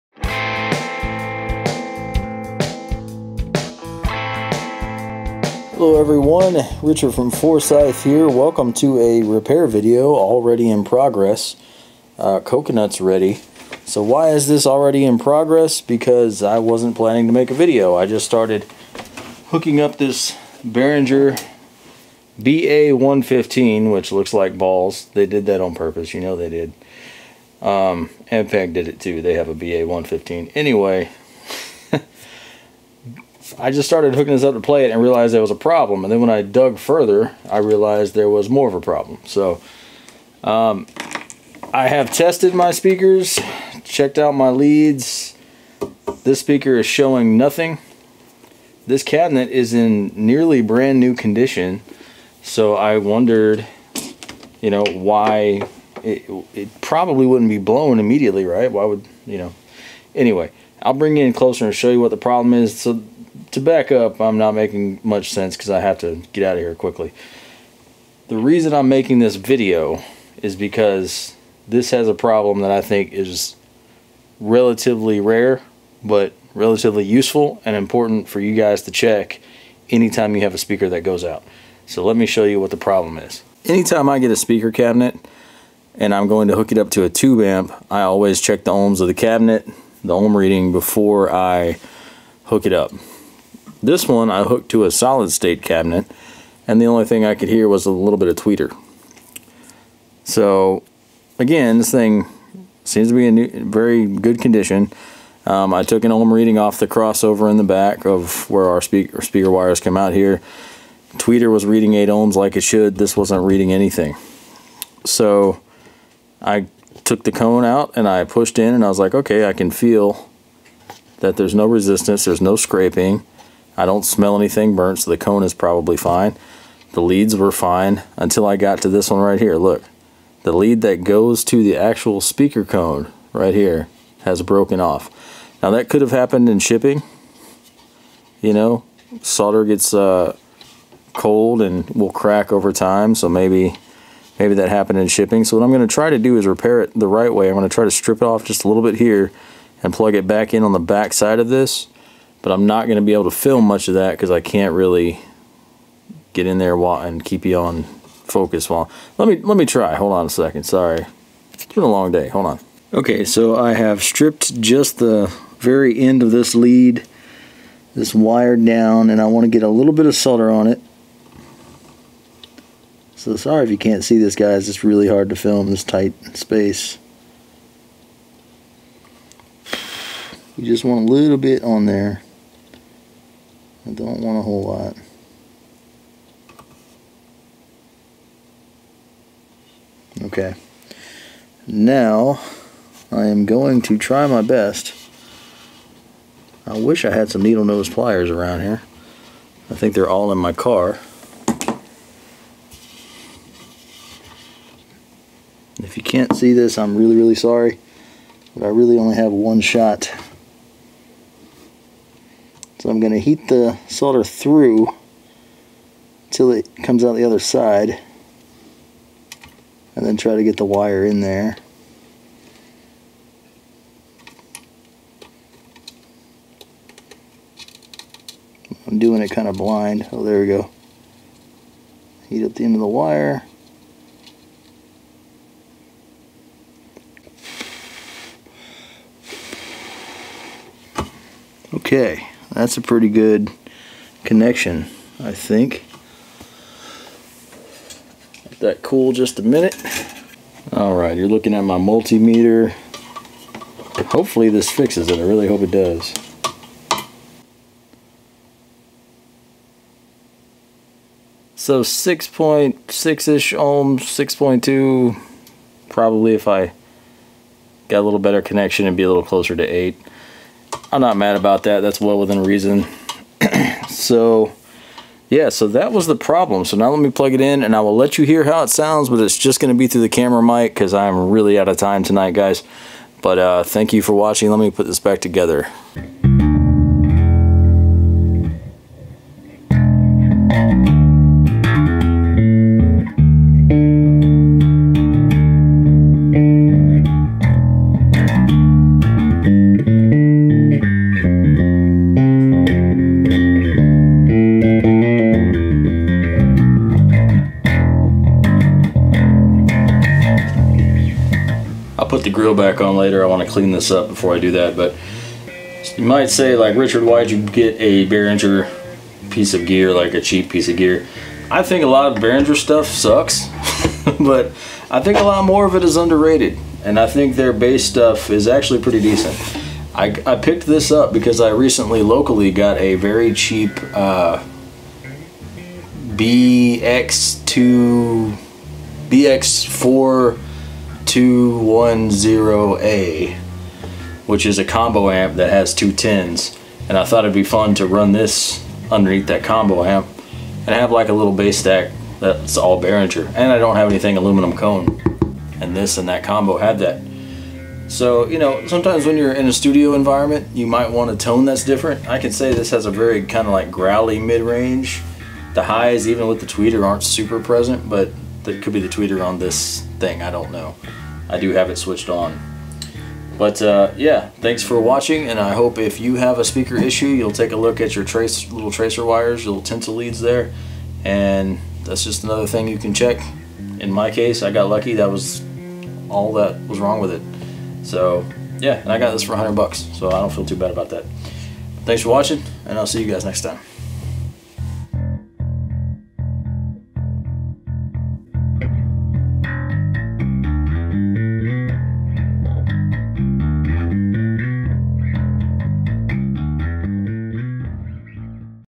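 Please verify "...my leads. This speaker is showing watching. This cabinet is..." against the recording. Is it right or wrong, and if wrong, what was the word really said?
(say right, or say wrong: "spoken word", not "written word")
wrong: "nothing", not "watching".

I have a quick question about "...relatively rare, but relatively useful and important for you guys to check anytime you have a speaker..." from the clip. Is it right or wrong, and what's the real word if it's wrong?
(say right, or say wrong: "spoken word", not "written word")
right.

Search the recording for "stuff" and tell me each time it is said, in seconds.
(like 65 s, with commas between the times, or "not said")
322 s, 327 s.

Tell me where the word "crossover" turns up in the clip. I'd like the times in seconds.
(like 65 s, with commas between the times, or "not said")
106 s.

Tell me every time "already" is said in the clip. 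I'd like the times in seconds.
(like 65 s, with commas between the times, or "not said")
10 s, 14 s.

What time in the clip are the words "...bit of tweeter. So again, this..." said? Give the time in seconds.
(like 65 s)
98 s.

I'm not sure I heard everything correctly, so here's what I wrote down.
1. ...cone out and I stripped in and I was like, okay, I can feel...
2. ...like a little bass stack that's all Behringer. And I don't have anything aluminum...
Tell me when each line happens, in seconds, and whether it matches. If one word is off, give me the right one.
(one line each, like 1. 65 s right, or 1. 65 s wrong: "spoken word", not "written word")
1. 117 s wrong: "pushed", not "stripped"
2. 350 s right.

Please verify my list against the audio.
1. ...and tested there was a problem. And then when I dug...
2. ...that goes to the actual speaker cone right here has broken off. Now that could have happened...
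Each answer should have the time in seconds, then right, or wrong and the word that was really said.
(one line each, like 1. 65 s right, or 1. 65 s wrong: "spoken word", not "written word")
1. 34 s wrong: "realized", not "tested"
2. 130 s right.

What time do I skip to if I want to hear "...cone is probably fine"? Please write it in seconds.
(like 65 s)
125 s.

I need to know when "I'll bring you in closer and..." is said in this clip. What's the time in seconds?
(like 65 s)
60 s.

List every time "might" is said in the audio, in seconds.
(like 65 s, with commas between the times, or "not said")
316 s, 360 s.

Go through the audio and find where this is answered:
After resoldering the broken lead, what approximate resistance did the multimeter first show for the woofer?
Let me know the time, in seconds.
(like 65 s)
261 s.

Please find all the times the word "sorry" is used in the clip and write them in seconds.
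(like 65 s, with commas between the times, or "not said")
160 s, 173 s, 207 s.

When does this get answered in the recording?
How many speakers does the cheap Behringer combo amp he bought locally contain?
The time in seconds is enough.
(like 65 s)
345 s.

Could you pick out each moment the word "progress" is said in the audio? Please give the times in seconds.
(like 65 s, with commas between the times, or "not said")
10 s, 15 s.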